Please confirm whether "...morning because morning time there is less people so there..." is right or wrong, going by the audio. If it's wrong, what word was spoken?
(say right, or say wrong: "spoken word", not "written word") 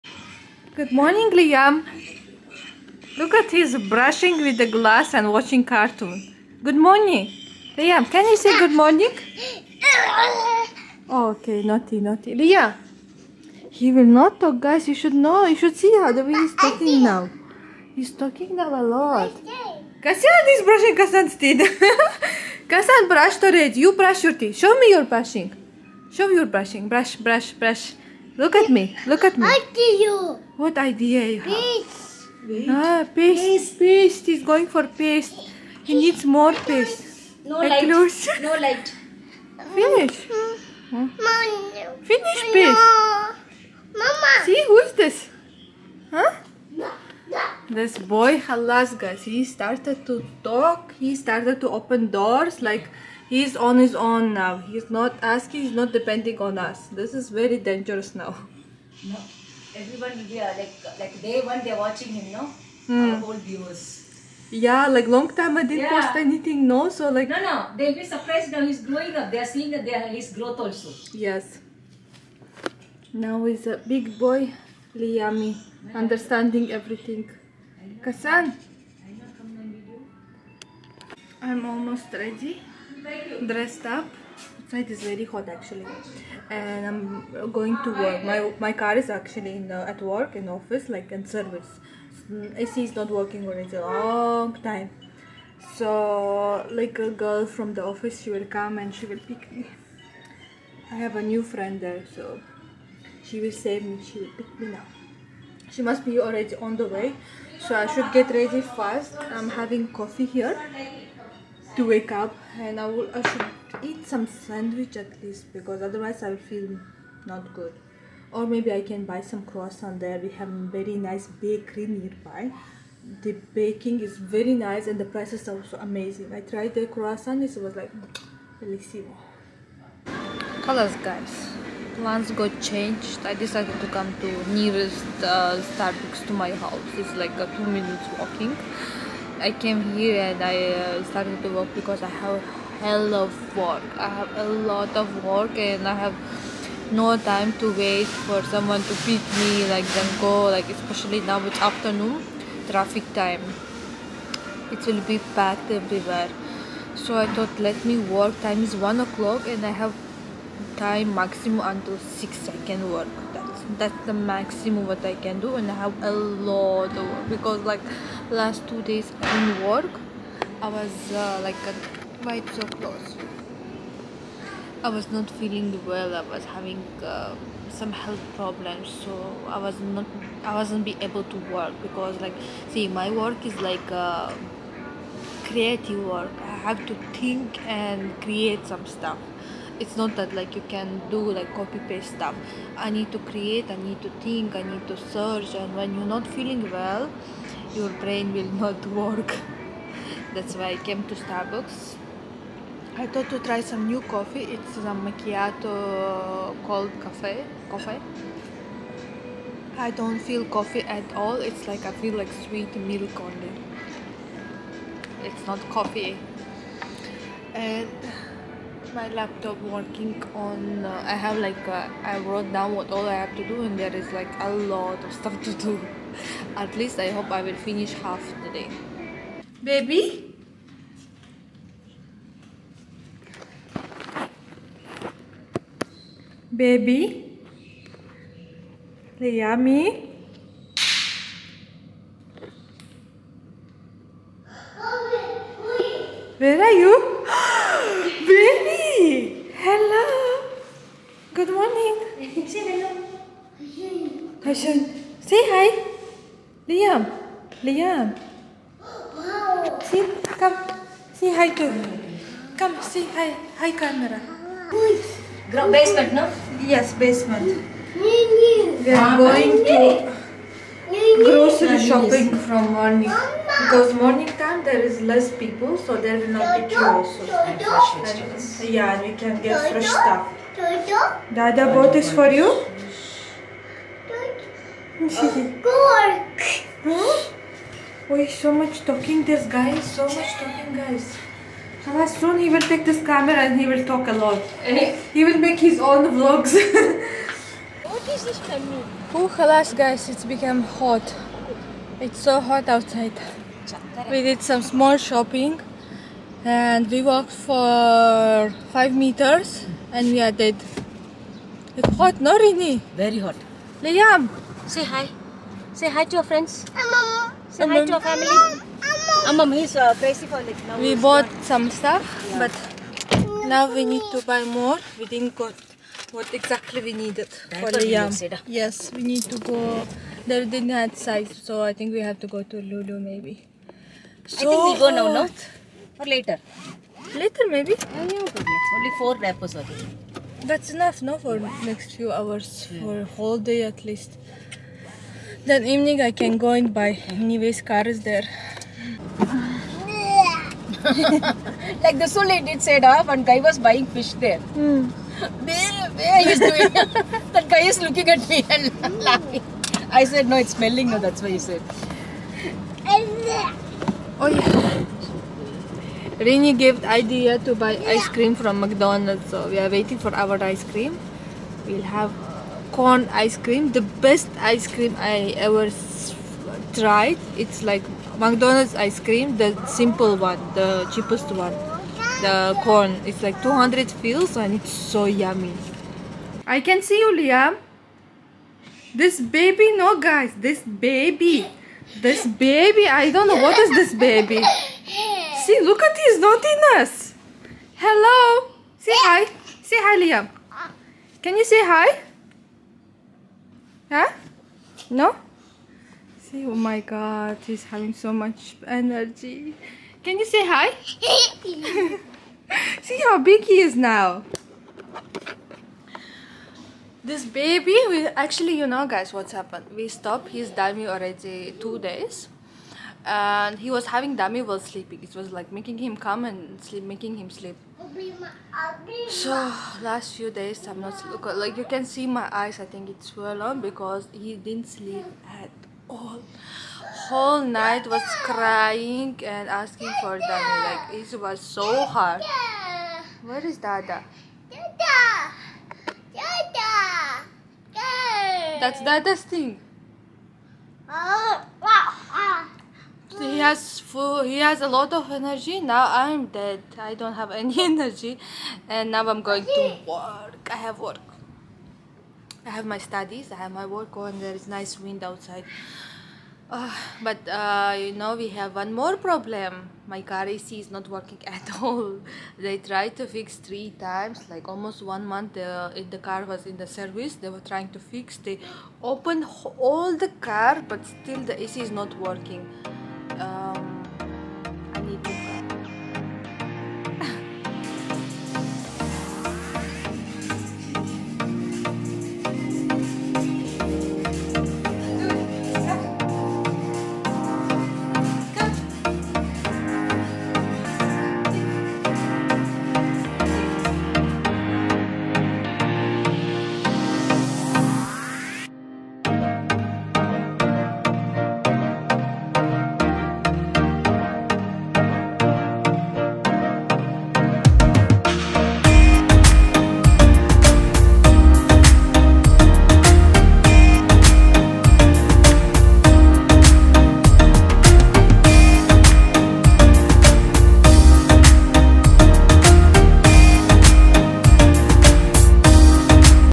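right.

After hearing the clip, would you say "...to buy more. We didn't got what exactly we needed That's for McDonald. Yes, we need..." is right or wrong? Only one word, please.
wrong.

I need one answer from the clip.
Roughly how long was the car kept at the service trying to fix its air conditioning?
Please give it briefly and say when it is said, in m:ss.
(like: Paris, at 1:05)
Almost one month, at 7:54.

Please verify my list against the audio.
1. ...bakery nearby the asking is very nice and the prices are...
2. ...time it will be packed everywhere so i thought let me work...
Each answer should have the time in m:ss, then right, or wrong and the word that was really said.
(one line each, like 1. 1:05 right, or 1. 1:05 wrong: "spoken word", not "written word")
1. 2:01 wrong: "baking", not "asking"
2. 2:33 right.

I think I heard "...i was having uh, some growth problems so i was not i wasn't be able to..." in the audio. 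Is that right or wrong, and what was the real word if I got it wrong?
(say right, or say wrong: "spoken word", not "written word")
wrong: "health", not "growth".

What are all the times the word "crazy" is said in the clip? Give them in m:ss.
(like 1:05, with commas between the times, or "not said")
5:19.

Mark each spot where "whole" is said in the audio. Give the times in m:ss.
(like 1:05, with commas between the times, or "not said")
1:03, 5:43, 7:17.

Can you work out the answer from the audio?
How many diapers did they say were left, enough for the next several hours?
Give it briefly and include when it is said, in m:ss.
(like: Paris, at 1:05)
4, at 5:38.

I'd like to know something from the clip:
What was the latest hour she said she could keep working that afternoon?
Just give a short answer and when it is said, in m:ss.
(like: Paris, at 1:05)
6, at 2:42.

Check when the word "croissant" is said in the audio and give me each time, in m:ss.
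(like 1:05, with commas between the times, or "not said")
1:59, 2:06.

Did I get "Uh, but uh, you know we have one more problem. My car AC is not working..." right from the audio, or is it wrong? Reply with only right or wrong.
right.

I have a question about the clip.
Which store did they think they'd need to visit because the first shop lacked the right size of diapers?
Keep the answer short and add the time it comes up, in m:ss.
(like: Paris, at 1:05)
Lulu, at 5:32.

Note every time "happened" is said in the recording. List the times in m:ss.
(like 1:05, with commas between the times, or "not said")
6:59.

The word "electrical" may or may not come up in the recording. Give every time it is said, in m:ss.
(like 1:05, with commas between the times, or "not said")
not said.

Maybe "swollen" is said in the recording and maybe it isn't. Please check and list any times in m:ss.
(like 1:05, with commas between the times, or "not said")
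7:13.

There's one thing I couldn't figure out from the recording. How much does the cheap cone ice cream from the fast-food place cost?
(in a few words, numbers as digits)
200 fils.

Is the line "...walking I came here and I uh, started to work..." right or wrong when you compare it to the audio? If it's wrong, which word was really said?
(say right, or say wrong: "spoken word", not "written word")
right.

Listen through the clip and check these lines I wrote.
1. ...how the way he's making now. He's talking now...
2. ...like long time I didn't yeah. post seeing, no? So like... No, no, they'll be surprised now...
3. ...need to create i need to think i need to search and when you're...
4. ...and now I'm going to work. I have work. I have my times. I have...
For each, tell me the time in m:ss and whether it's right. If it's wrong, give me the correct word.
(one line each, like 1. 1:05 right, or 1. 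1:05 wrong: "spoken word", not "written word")
1. 0:15 wrong: "talking", not "making"
2. 1:04 wrong: "anything", not "seeing"
3. 3:12 right
4. 7:38 wrong: "studies", not "times".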